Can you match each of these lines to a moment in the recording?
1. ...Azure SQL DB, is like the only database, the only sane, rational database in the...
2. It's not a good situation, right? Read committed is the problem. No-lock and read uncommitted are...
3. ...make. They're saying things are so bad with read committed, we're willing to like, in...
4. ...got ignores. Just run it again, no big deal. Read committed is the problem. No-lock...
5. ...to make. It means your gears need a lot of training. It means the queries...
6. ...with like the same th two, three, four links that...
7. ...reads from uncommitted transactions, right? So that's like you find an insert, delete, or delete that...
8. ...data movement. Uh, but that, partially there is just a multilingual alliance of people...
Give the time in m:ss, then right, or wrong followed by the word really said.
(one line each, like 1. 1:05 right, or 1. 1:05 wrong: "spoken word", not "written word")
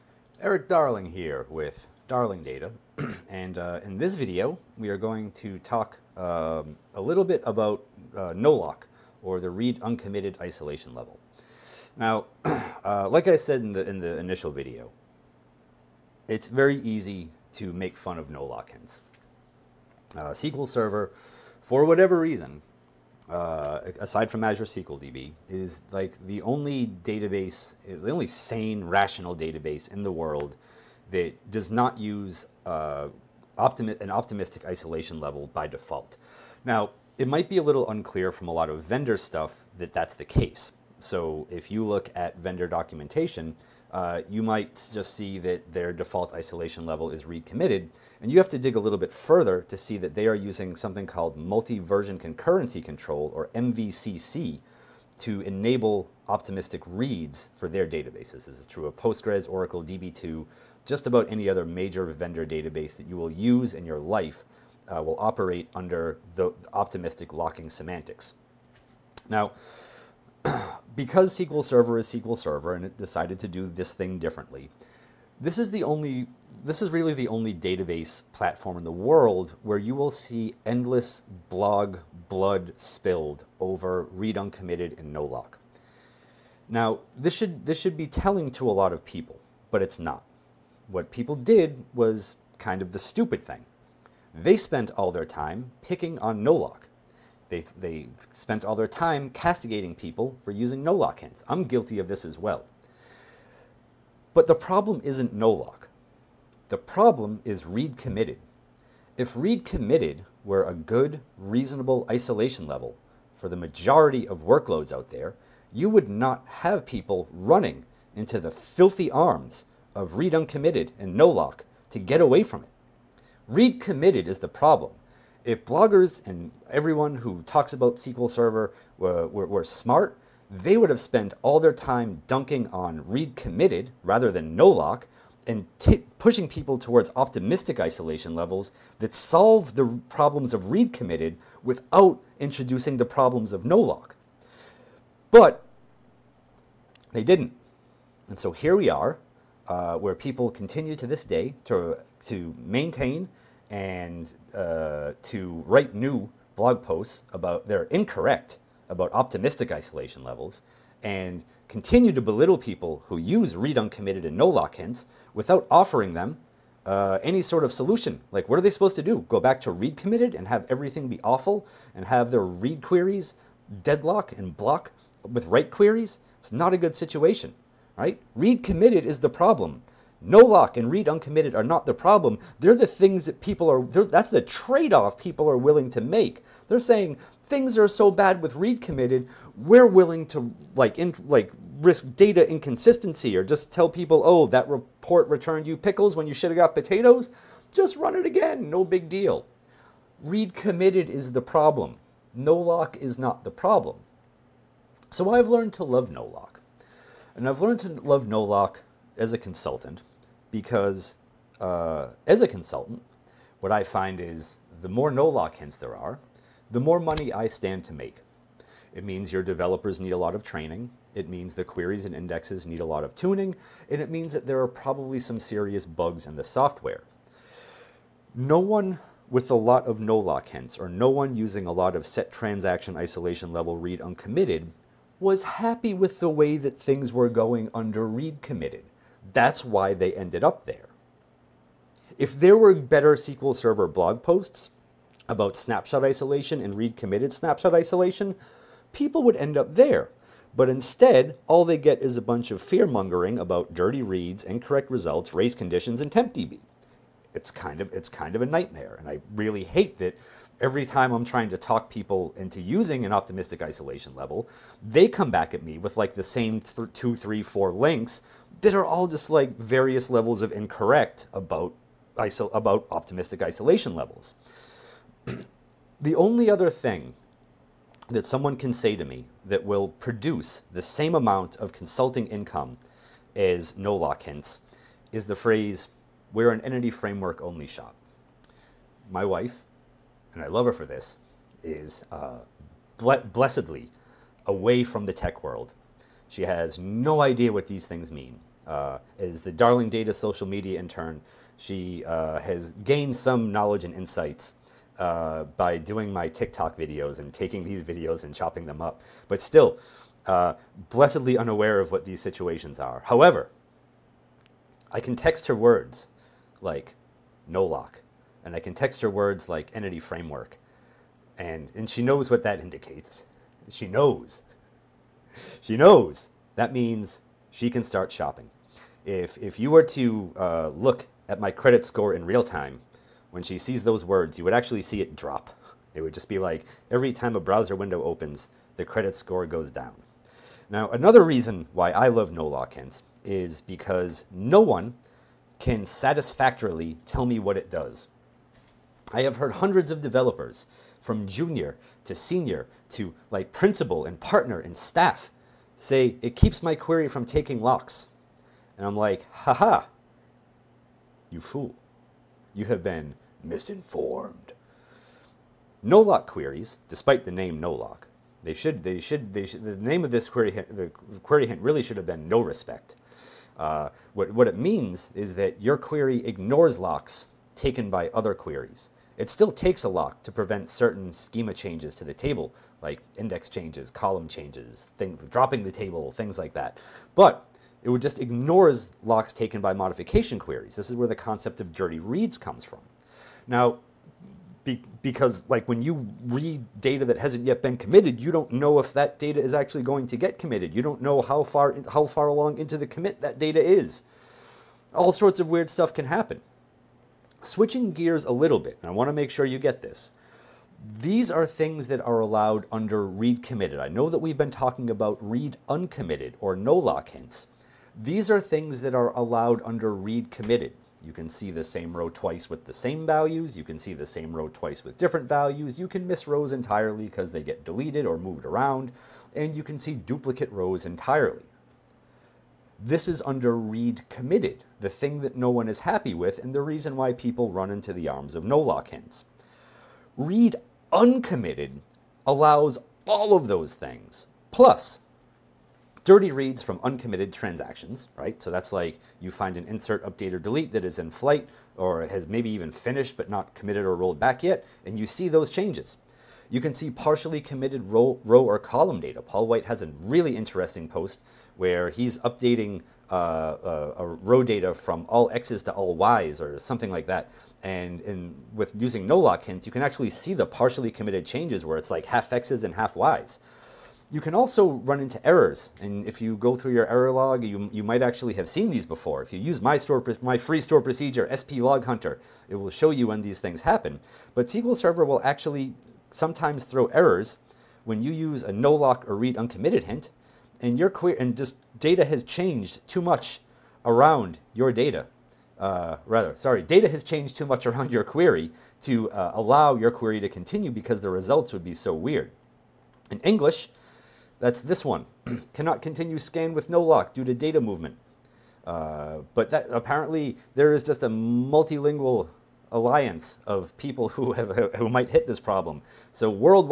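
1. 0:24 right
2. 2:56 right
3. 3:06 right
4. 3:16 wrong: "potatoes", not "ignores"
5. 3:37 wrong: "developers", not "gears"
6. 4:25 right
7. 7:26 wrong: "update", not "delete"
8. 8:27 wrong: "apparently", not "partially".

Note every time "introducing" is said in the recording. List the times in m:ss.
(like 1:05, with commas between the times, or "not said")
2:22.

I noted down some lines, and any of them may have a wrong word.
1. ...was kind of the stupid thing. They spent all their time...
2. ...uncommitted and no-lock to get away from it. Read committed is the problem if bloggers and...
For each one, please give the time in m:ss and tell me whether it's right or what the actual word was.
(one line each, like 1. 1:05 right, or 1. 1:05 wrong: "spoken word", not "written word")
1. 1:31 right
2. 2:00 right.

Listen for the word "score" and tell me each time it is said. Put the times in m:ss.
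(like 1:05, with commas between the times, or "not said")
5:31, 5:39.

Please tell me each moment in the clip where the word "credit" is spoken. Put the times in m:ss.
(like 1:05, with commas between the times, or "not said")
5:31, 5:38.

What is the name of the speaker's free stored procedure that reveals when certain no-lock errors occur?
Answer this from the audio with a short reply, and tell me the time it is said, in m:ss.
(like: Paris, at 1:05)
sp_LogHunter, at 8:01.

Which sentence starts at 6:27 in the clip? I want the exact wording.
But it would just ignores locks taken by modification queries.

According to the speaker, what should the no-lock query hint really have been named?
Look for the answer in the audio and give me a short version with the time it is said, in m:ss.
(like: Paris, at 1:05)
no respect, at 6:12.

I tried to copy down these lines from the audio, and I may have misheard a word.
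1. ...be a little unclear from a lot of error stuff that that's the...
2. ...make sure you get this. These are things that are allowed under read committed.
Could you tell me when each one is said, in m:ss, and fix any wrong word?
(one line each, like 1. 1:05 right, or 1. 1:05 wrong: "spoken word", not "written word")
1. 0:37 wrong: "vendor", not "error"
2. 6:49 right.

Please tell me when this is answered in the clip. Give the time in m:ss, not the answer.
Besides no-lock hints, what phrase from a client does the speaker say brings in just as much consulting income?
4:46.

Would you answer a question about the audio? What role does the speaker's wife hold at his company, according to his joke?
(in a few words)
social media intern.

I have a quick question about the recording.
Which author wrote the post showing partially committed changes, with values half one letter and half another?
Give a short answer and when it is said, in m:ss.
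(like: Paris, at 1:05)
Paul White, at 7:39.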